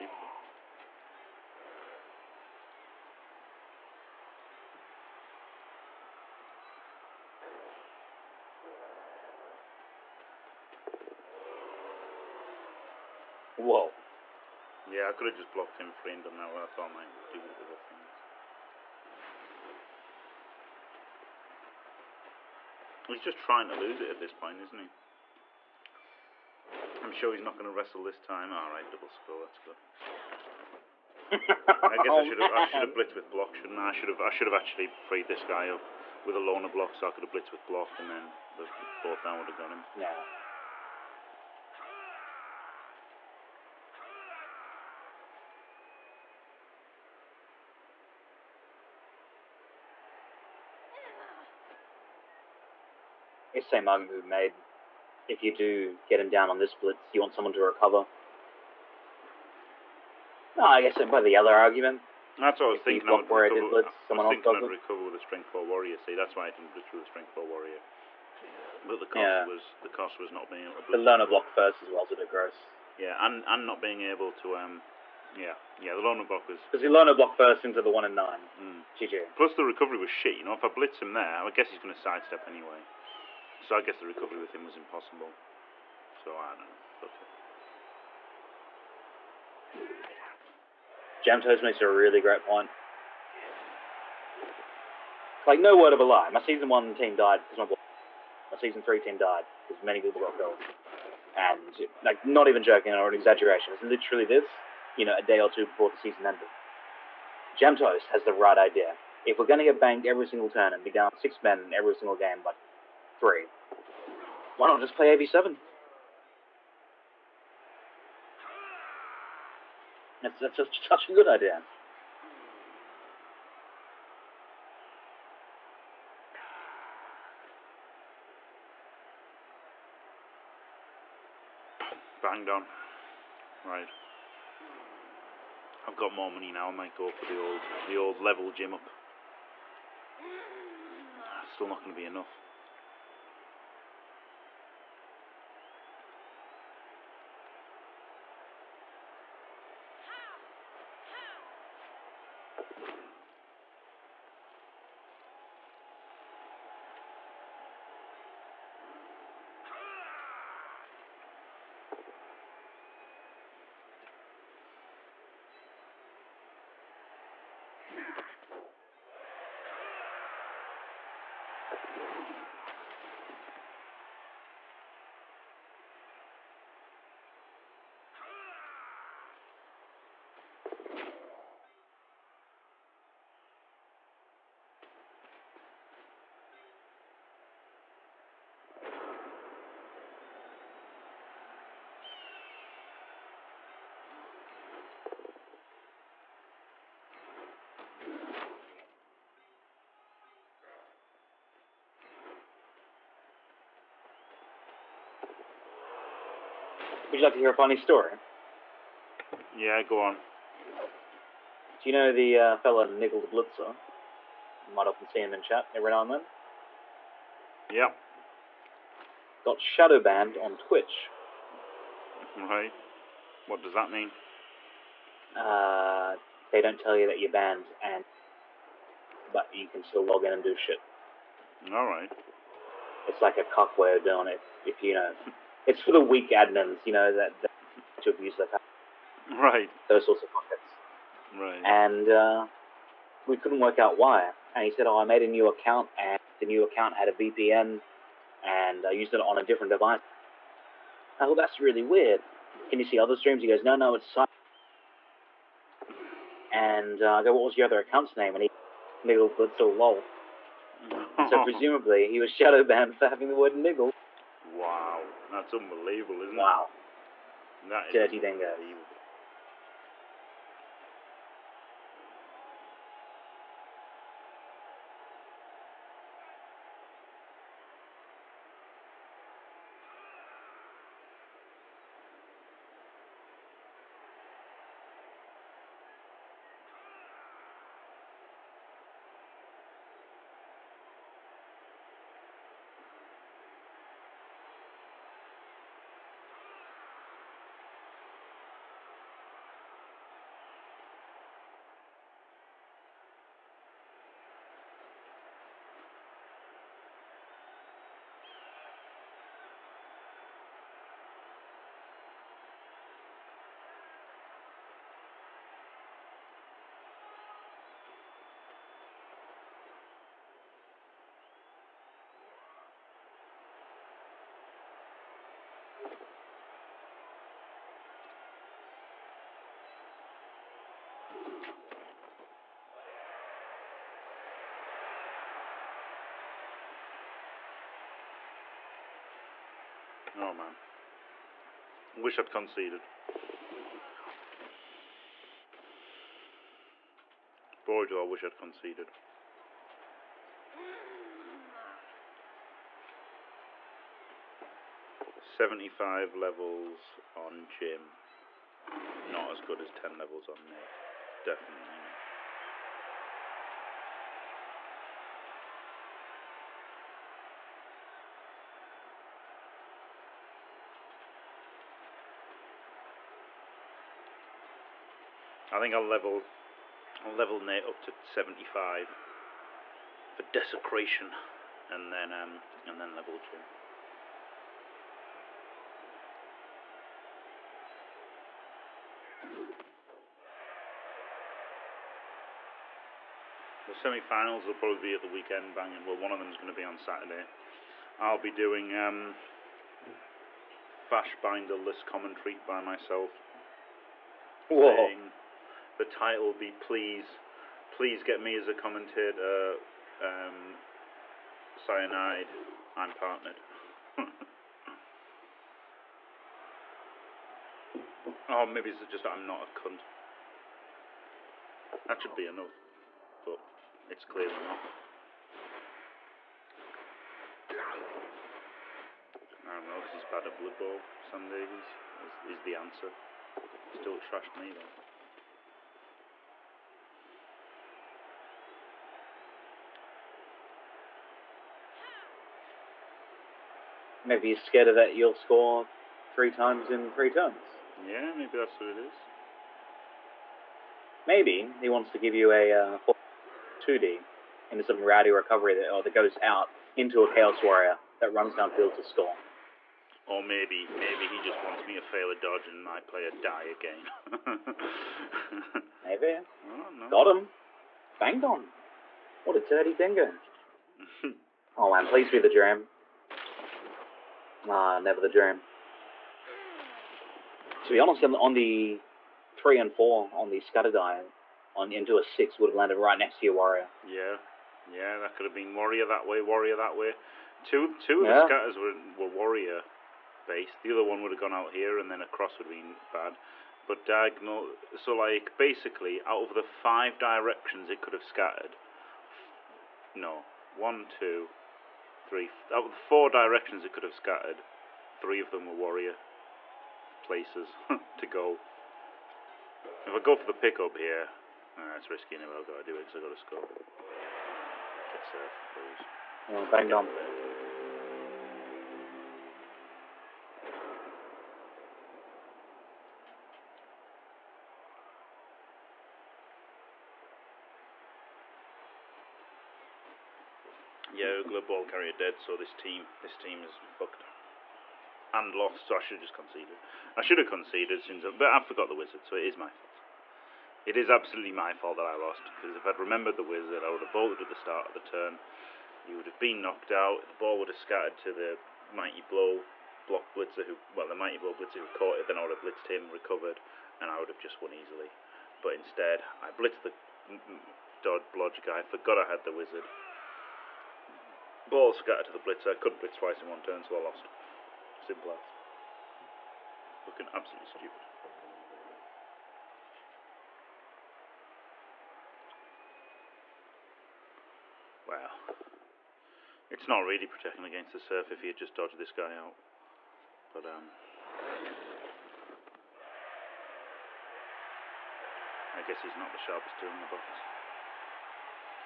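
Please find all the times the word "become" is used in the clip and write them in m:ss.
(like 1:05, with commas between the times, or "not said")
not said.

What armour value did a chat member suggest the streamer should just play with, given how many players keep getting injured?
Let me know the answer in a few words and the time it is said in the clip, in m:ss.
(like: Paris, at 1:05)
AV7, at 1:55.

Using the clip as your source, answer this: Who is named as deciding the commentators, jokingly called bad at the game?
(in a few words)
Sam Davies.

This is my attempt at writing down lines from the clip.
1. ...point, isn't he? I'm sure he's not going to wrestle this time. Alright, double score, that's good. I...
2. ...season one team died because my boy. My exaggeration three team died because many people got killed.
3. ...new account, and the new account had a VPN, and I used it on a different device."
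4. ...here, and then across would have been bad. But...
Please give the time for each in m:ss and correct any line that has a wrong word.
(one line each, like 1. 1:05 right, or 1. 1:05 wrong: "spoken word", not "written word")
1. 0:24 right
2. 1:36 wrong: "season", not "exaggeration"
3. 4:05 right
4. 8:11 right.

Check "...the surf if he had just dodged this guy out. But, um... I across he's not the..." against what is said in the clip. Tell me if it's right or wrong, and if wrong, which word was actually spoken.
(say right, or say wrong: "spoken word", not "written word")
wrong: "guess", not "across".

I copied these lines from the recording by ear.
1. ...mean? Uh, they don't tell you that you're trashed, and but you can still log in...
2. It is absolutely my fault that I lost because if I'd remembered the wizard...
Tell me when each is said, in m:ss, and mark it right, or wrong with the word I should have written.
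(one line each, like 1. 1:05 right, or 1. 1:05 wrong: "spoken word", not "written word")
1. 3:43 wrong: "banned", not "trashed"
2. 9:00 right.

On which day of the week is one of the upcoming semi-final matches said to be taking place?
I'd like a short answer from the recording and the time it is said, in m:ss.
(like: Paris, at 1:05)
Saturday, at 6:36.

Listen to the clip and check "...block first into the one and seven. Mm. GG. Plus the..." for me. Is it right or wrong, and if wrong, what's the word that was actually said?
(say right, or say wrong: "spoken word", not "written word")
wrong: "nine", not "seven".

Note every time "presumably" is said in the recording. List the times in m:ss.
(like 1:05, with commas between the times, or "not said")
4:21.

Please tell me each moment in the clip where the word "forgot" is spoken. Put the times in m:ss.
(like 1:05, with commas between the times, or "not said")
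8:58, 9:18.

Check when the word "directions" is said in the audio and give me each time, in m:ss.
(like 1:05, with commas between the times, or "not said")
8:16, 8:23.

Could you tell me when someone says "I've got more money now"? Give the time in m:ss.
2:15.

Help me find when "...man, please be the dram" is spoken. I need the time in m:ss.
7:51.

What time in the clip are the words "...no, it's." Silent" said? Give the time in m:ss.
4:13.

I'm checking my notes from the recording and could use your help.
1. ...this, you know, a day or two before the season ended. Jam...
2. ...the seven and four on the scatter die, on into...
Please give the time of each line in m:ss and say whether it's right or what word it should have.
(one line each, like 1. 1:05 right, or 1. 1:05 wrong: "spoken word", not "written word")
1. 1:44 right
2. 7:58 wrong: "three", not "seven".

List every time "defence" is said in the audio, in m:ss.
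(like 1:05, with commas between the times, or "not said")
not said.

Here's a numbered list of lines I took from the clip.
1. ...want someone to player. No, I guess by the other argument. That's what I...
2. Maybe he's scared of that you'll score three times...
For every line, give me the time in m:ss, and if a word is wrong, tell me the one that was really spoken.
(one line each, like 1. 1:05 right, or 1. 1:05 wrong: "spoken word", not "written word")
1. 0:57 wrong: "recover", not "player"
2. 7:24 right.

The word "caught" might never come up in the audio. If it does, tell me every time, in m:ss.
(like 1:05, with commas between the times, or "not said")
9:11.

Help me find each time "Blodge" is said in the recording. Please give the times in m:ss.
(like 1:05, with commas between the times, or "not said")
9:18.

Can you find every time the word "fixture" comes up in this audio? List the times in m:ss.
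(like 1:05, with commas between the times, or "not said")
not said.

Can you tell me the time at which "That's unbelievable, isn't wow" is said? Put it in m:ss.
4:25.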